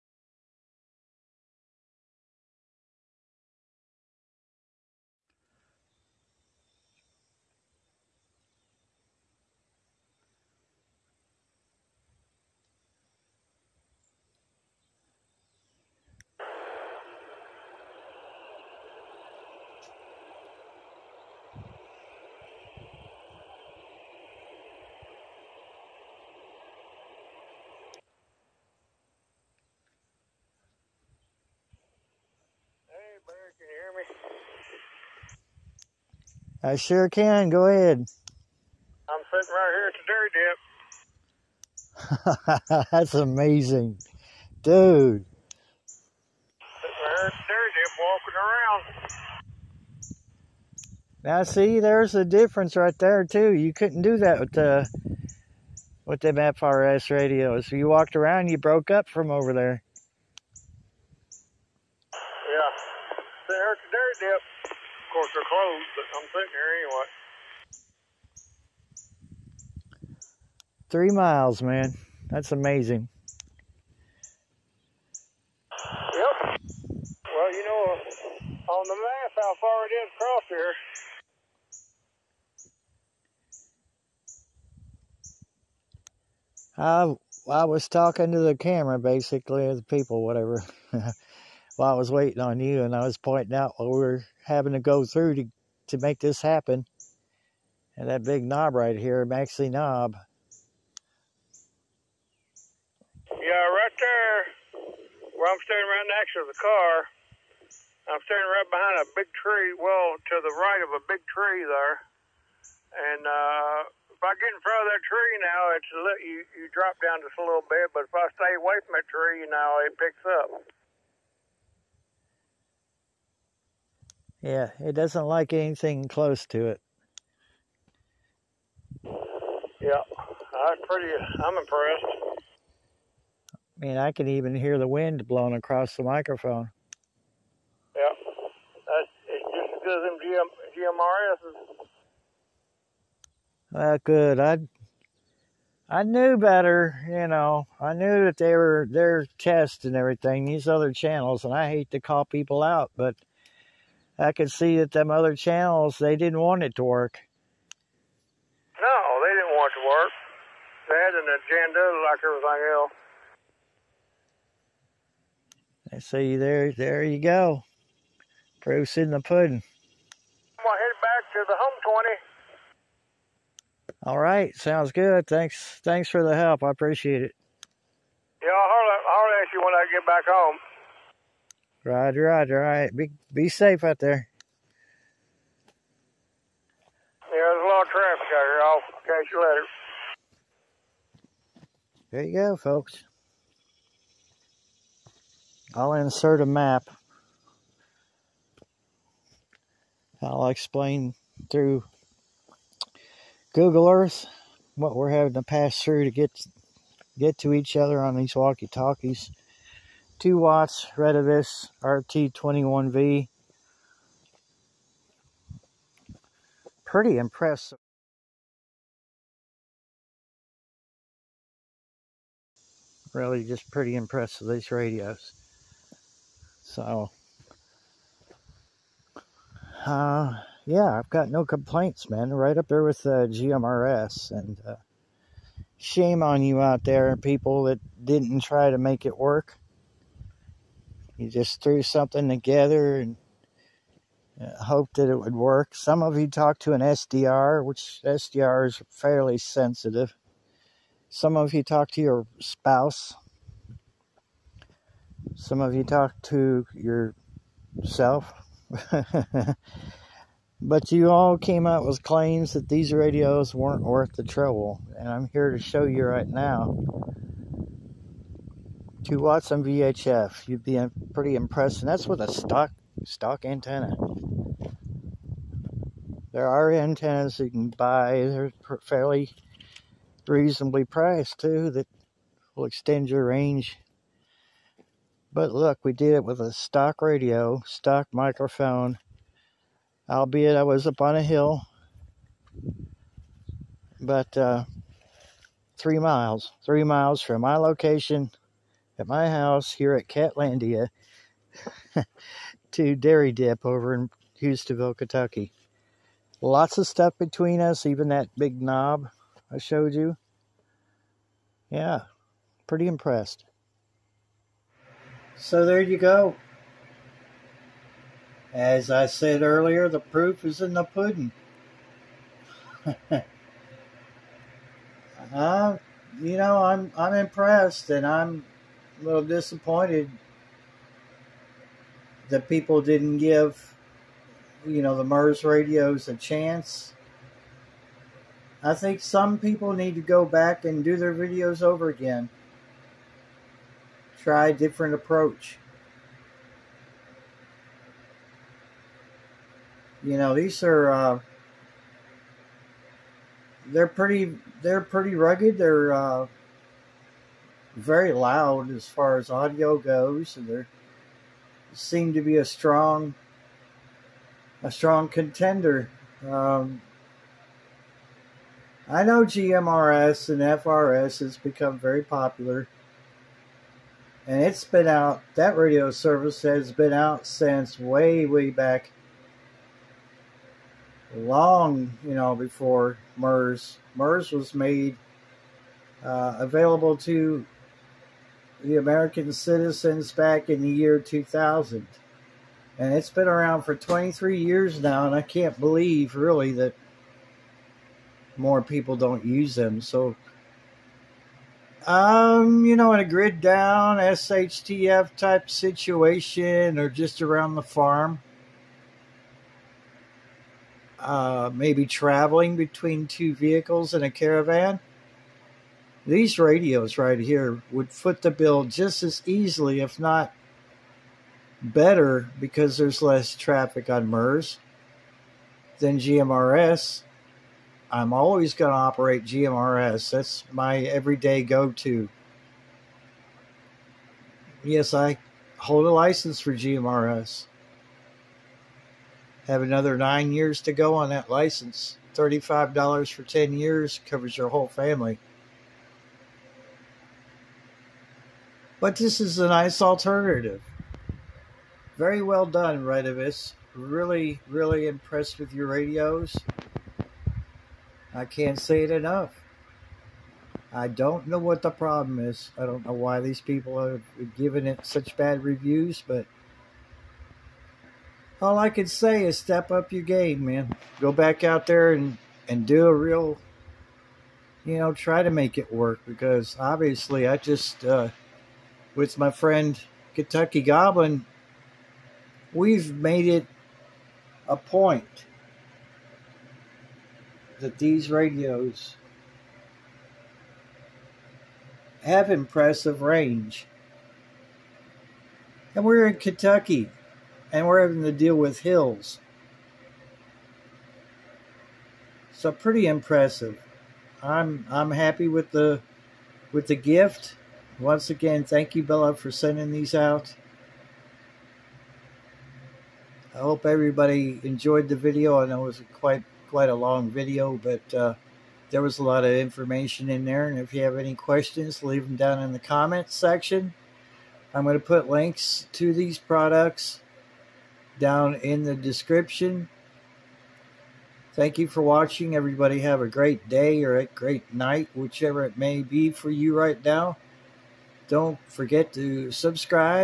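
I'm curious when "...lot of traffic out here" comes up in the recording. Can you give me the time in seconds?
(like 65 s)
187 s.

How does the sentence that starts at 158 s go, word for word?
No, they didn't want it to work.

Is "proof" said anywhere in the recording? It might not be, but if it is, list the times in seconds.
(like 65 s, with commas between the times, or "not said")
168 s, 319 s.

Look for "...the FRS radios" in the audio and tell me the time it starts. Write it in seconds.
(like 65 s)
56 s.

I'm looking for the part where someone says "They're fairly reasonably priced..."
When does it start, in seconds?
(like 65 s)
278 s.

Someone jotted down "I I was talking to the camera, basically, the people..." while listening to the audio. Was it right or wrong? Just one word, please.
right.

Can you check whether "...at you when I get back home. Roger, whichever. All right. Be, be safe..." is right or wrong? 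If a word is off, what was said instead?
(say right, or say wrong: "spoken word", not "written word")
wrong: "roger", not "whichever".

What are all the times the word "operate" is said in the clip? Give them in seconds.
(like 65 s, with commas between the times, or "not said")
428 s.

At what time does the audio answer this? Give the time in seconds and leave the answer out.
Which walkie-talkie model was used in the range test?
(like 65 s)
210 s.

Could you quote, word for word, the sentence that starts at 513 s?
I hope everybody enjoyed the video.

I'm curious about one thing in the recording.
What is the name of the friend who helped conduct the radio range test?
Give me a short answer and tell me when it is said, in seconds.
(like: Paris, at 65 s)
Kentucky Goblin, at 480 s.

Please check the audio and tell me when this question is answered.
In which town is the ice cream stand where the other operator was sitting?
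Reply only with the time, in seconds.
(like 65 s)
304 s.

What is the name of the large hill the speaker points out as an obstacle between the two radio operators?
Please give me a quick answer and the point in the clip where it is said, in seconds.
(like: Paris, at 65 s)
Maxi Knob, at 99 s.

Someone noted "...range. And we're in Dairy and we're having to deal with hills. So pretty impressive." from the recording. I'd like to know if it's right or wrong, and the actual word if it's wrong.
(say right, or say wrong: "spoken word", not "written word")
wrong: "Kentucky", not "Dairy".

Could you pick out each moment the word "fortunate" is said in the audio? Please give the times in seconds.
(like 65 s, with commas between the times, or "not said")
not said.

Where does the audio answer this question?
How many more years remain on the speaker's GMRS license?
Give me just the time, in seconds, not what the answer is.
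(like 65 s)
439 s.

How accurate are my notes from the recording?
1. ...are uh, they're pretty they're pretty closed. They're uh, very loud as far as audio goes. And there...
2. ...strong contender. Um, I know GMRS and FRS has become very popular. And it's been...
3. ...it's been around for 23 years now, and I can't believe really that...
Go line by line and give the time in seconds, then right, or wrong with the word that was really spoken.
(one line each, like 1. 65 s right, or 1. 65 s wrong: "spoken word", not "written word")
1. 350 s wrong: "rugged", not "closed"
2. 364 s right
3. 392 s right.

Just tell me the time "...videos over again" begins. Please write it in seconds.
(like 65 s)
341 s.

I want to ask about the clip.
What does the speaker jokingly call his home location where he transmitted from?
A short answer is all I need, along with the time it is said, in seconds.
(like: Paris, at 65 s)
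Catlandia, at 300 s.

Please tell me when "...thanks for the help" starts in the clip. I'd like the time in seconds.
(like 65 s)
175 s.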